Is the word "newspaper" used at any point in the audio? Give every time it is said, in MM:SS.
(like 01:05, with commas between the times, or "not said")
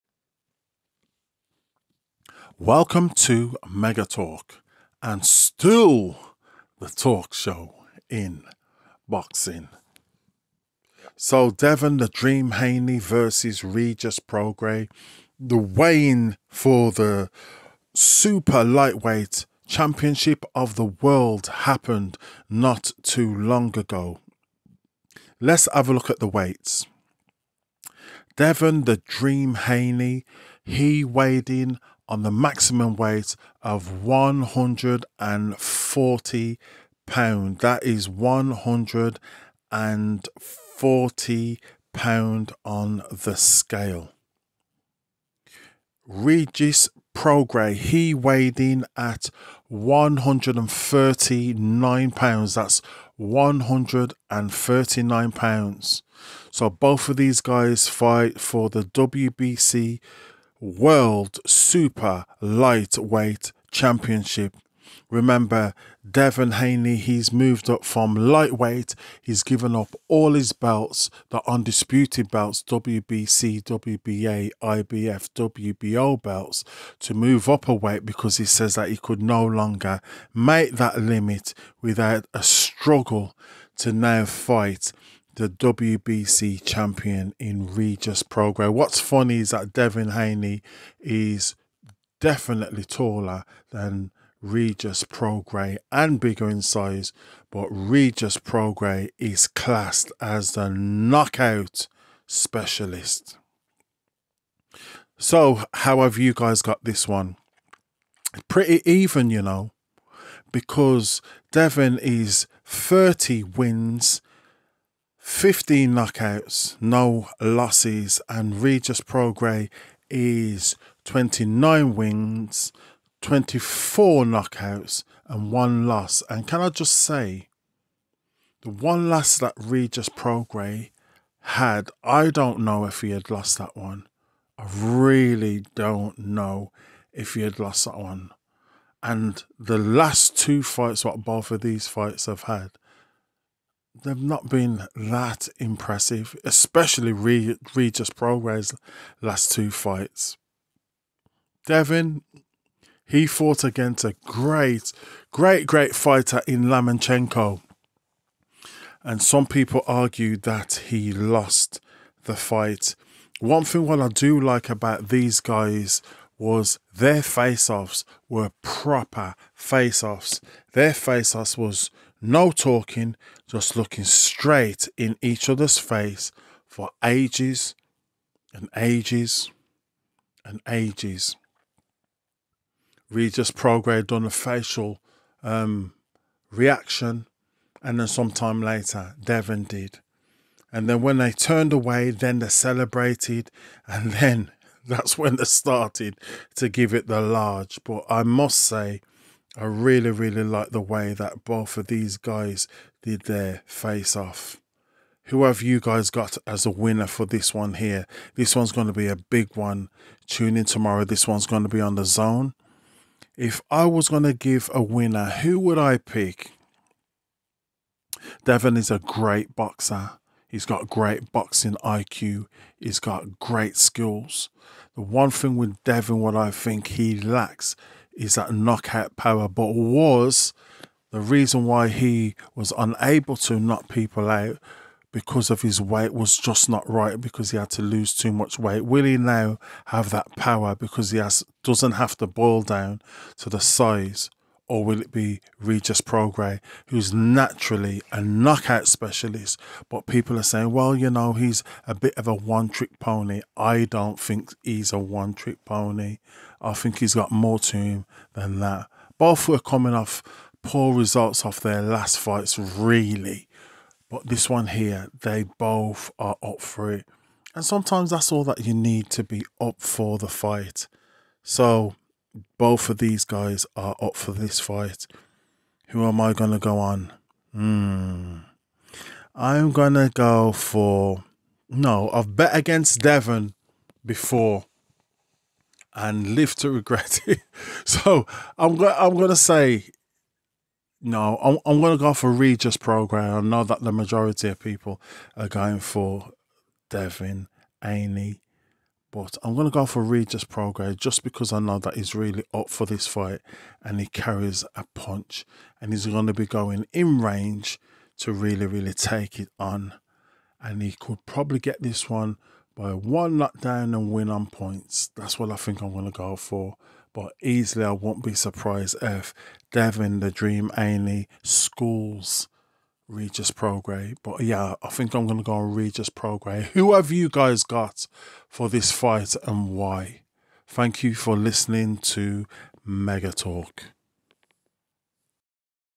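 not said.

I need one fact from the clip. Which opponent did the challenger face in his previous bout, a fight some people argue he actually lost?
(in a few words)
Lomachenko.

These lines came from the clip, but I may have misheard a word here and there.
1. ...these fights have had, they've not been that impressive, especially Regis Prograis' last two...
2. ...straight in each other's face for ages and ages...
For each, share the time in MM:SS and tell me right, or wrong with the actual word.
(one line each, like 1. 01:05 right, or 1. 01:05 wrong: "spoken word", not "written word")
1. 02:21 right
2. 02:54 right.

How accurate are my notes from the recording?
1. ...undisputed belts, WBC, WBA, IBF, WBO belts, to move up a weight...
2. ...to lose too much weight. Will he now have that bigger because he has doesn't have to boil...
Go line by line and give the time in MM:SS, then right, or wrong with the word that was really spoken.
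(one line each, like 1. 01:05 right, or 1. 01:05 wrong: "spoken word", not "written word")
1. 01:11 right
2. 03:57 wrong: "power", not "bigger".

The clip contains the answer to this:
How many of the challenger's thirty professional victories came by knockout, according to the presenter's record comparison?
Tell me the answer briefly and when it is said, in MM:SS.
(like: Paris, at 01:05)
15, at 01:55.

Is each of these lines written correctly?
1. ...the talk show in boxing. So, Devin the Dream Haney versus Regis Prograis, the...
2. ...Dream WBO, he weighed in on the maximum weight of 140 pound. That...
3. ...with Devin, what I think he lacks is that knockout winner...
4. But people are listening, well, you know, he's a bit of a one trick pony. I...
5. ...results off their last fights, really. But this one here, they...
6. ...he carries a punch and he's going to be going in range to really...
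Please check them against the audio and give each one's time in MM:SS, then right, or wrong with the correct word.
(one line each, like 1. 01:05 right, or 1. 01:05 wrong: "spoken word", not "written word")
1. 00:06 right
2. 00:28 wrong: "Haney", not "WBO"
3. 03:45 wrong: "power", not "winner"
4. 04:09 wrong: "saying", not "listening"
5. 04:20 right
6. 05:03 right.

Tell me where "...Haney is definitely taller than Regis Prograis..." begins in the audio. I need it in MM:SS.
01:30.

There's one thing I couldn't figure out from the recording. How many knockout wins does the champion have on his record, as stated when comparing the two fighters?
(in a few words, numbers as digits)
24.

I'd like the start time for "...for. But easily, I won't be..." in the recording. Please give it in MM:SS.
05:16.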